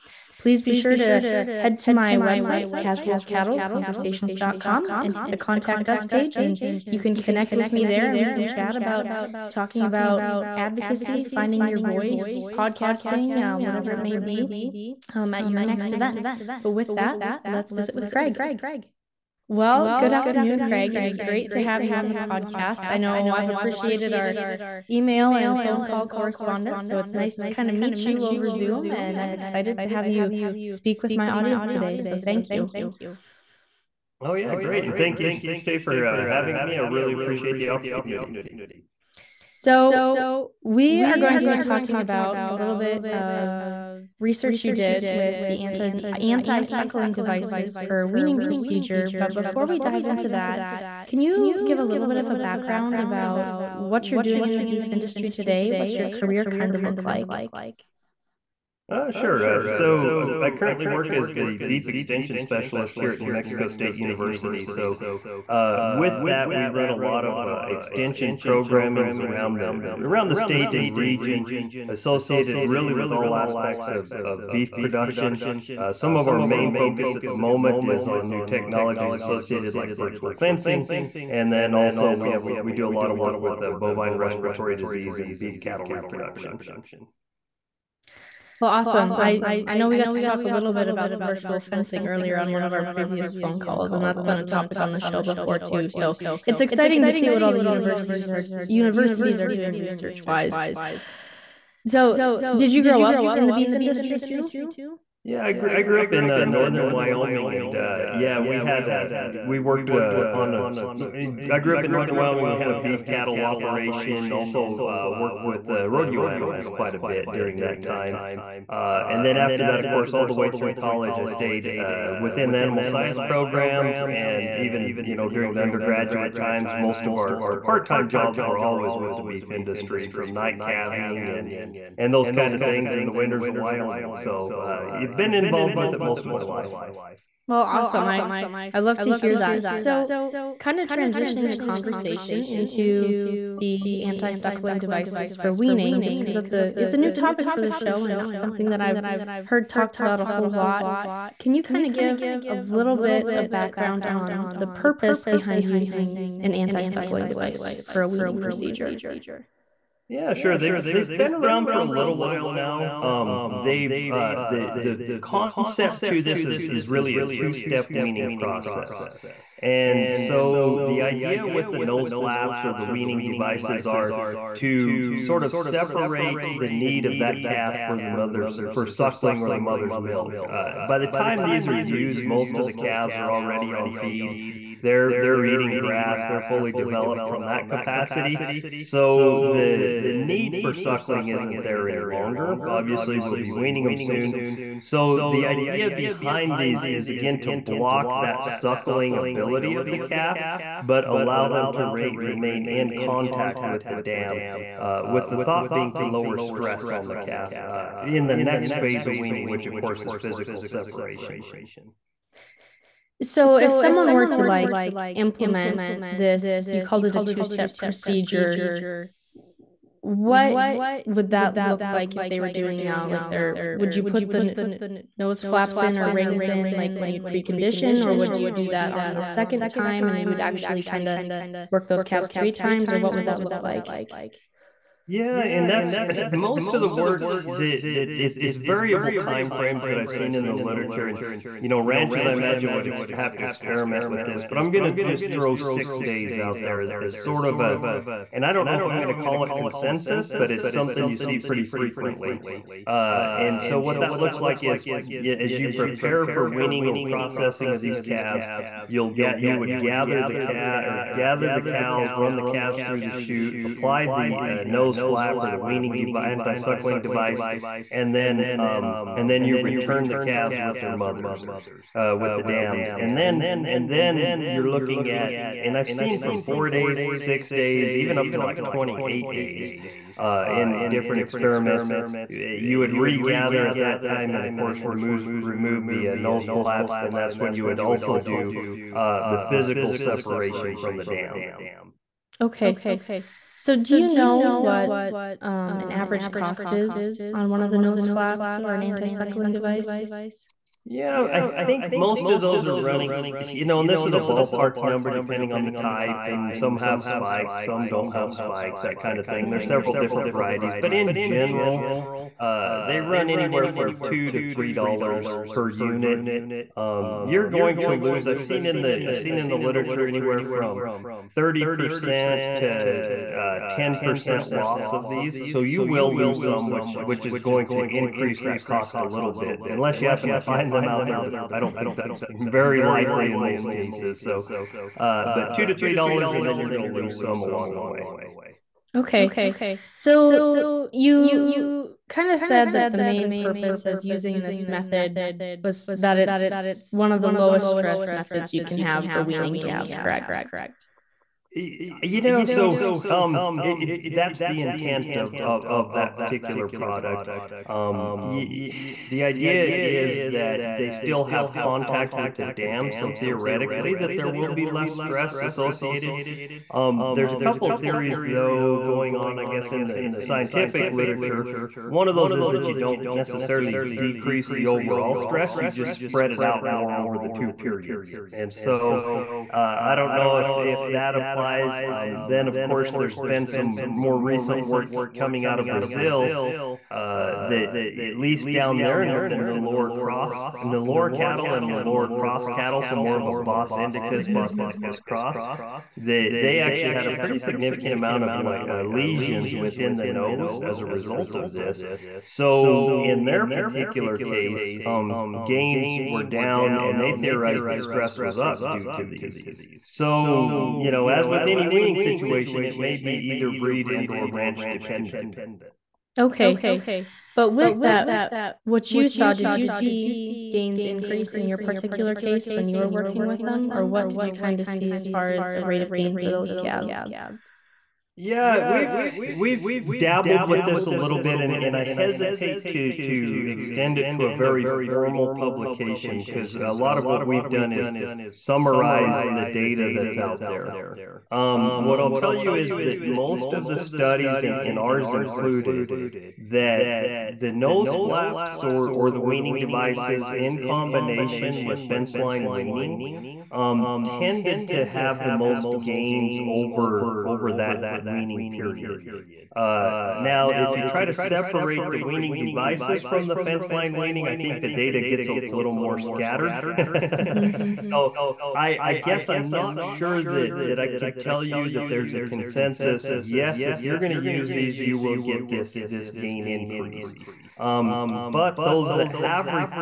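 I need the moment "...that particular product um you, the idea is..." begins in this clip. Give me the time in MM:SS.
05:55.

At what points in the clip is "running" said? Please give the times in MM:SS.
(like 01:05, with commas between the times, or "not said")
05:02.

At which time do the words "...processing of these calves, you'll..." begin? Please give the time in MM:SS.
04:17.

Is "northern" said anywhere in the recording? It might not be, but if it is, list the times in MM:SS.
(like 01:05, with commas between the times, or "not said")
01:46, 01:51.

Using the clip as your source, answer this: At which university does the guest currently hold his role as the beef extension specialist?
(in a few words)
New Mexico State University.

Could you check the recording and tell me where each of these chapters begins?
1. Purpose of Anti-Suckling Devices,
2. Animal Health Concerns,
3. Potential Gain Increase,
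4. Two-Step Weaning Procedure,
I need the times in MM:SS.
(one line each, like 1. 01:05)
1. 00:45
2. 07:03
3. 03:54
4. 01:59.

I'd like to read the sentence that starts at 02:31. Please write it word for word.
Can you kind of give a little bit of background on the purpose behind using an anti-suckling device for a weaning procedure?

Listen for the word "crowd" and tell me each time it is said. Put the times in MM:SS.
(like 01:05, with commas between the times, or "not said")
not said.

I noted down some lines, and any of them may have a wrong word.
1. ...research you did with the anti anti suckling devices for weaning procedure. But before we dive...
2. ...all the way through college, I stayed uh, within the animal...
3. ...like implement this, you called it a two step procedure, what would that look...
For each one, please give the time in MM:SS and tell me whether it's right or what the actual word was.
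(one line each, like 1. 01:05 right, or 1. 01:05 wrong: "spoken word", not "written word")
1. 00:44 right
2. 02:00 right
3. 03:34 right.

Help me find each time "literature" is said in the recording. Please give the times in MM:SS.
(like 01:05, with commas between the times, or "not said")
04:00, 05:19, 06:10.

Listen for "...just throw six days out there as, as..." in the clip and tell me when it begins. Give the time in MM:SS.
04:04.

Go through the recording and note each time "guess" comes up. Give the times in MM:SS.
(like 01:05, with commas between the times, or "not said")
06:09, 07:48.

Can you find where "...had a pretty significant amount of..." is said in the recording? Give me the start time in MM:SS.
06:36.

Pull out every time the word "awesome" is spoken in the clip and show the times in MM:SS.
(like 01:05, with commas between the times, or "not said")
01:28, 02:17.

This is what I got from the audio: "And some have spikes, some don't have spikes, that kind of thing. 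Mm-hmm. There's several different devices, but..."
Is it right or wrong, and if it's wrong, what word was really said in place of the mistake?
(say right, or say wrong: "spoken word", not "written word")
wrong: "varieties", not "devices".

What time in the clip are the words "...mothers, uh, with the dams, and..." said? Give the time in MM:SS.
04:30.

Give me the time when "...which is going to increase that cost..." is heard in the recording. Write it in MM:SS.
05:27.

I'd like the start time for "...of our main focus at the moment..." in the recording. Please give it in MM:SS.
01:16.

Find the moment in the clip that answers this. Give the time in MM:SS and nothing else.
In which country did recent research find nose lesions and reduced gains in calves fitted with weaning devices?
06:25.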